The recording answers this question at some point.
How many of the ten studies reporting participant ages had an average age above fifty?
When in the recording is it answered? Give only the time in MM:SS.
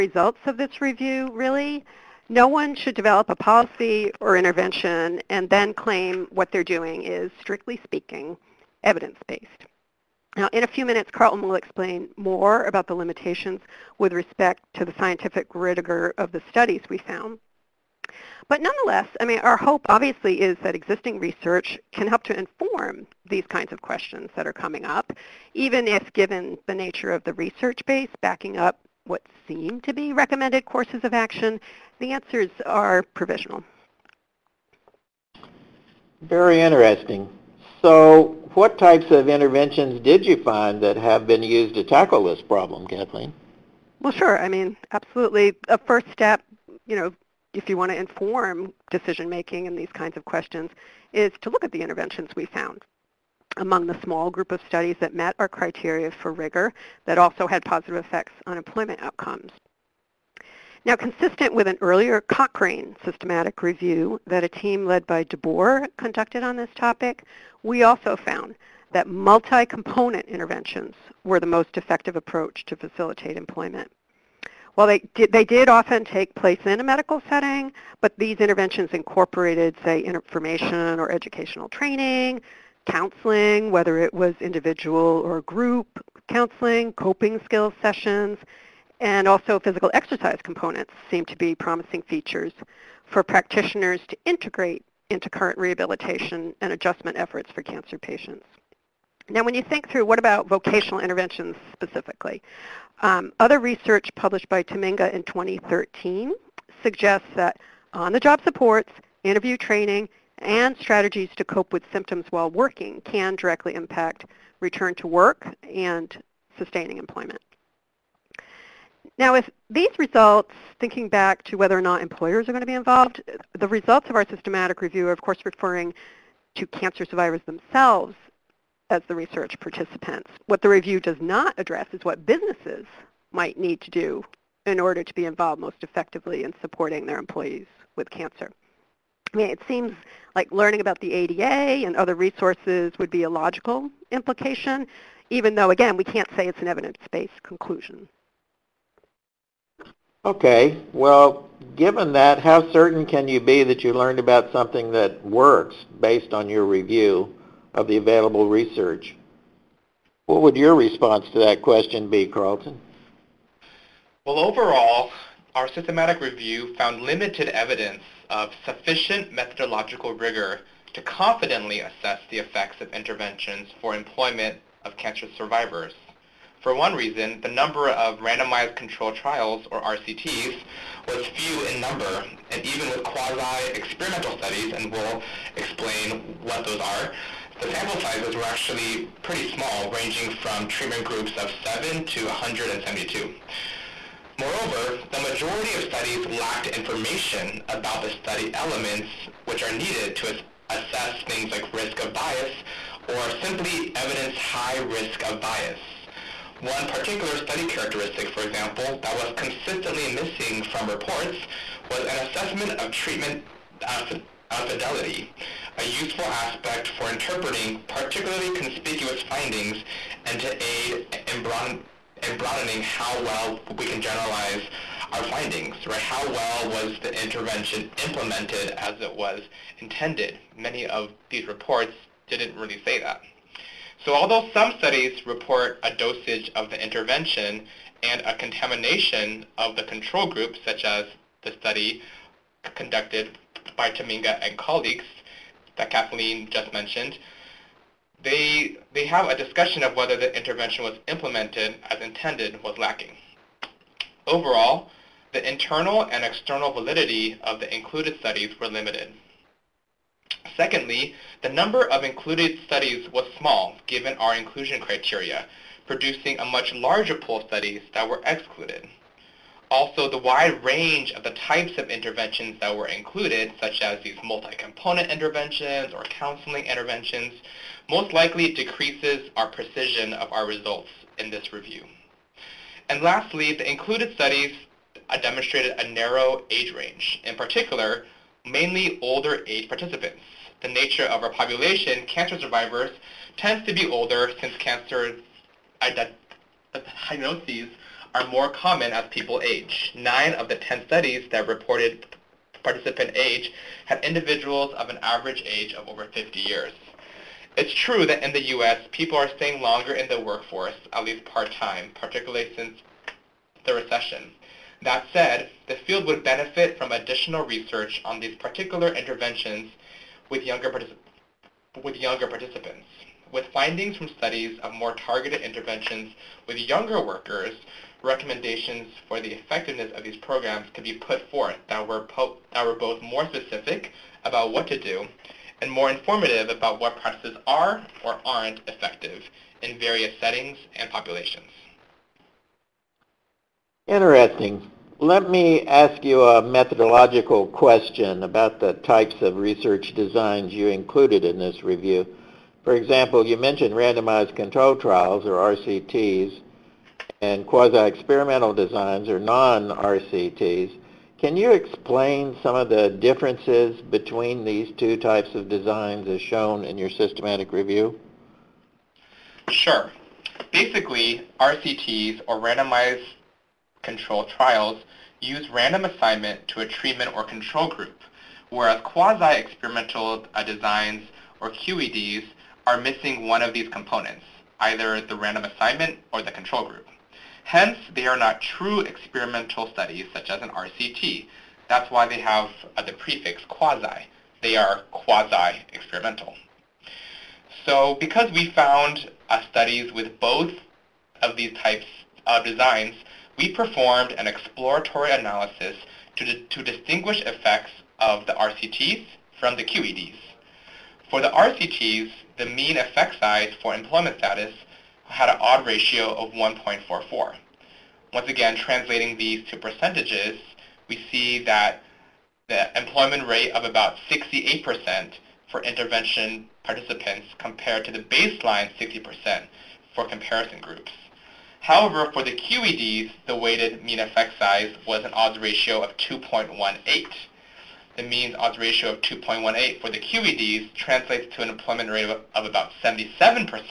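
04:59.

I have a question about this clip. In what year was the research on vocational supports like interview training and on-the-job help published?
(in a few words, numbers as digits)
2013.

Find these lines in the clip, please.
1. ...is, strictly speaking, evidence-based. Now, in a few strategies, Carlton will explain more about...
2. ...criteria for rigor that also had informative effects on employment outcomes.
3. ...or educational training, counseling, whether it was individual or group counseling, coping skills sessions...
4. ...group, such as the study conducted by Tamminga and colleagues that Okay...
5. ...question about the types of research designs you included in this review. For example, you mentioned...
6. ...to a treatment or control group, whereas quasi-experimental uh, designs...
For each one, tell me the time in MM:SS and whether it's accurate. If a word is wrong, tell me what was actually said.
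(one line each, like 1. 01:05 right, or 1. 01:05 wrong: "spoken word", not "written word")
1. 00:07 wrong: "minutes", not "strategies"
2. 00:55 wrong: "positive", not "informative"
3. 01:20 right
4. 04:00 wrong: "Kathleen", not "Okay"
5. 05:47 right
6. 06:16 right.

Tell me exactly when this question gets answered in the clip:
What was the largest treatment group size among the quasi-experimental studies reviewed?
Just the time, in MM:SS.
03:12.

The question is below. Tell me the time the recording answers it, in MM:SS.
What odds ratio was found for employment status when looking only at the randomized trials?
06:56.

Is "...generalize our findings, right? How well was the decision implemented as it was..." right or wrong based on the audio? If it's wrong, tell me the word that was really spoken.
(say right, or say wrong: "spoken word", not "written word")
wrong: "intervention", not "decision".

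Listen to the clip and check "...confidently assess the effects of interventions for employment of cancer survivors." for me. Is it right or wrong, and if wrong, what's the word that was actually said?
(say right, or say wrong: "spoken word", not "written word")
right.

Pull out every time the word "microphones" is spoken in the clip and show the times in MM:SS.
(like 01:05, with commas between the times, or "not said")
not said.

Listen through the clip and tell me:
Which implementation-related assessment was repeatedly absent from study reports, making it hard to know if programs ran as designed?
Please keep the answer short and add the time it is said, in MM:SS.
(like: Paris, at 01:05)
treatment fidelity, at 03:32.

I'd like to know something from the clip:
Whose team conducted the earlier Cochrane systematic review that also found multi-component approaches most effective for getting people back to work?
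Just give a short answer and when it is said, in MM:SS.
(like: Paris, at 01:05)
DeBoer, at 01:05.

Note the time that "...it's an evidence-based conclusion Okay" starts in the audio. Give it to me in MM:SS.
02:26.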